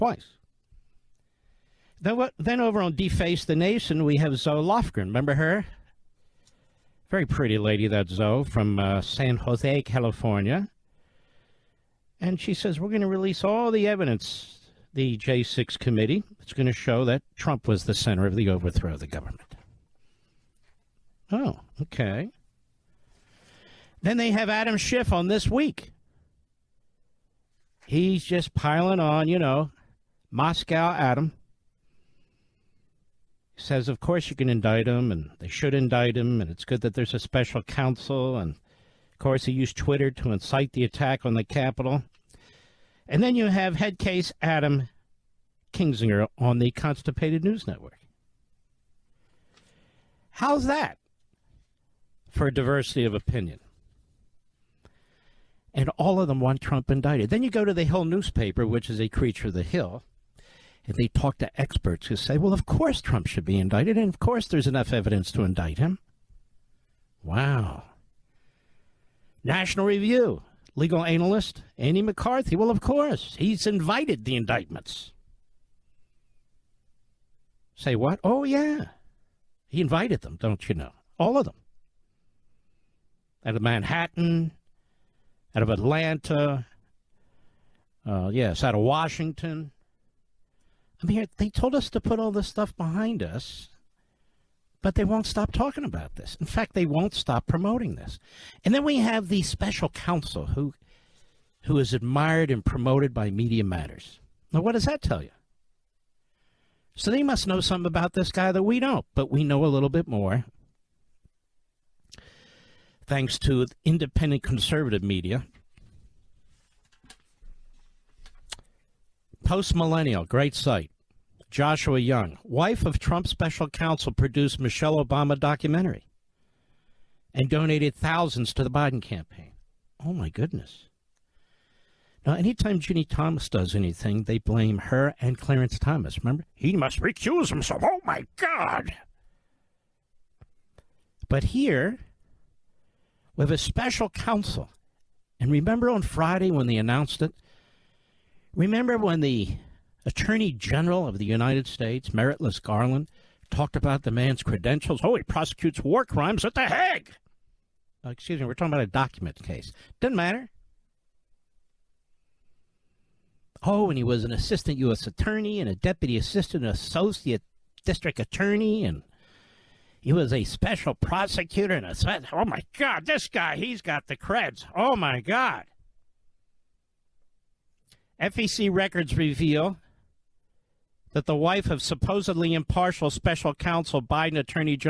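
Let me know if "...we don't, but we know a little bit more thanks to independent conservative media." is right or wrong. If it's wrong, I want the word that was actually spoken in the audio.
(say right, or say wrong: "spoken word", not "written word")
right.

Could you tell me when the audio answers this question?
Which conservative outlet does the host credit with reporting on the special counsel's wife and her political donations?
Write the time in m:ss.
1:59.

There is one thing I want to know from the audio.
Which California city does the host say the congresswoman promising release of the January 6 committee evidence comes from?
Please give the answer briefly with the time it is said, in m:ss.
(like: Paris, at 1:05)
San Jose, at 0:09.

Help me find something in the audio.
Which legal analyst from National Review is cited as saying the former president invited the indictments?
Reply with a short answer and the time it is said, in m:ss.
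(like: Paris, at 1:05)
Andy McCarthy, at 1:11.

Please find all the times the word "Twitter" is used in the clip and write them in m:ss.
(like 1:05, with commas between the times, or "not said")
0:39.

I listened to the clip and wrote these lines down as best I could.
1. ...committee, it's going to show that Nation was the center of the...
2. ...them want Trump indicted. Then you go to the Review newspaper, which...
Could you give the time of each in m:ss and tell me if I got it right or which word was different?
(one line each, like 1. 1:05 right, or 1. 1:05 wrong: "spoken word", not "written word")
1. 0:15 wrong: "Trump", not "Nation"
2. 0:56 wrong: "Hill", not "Review".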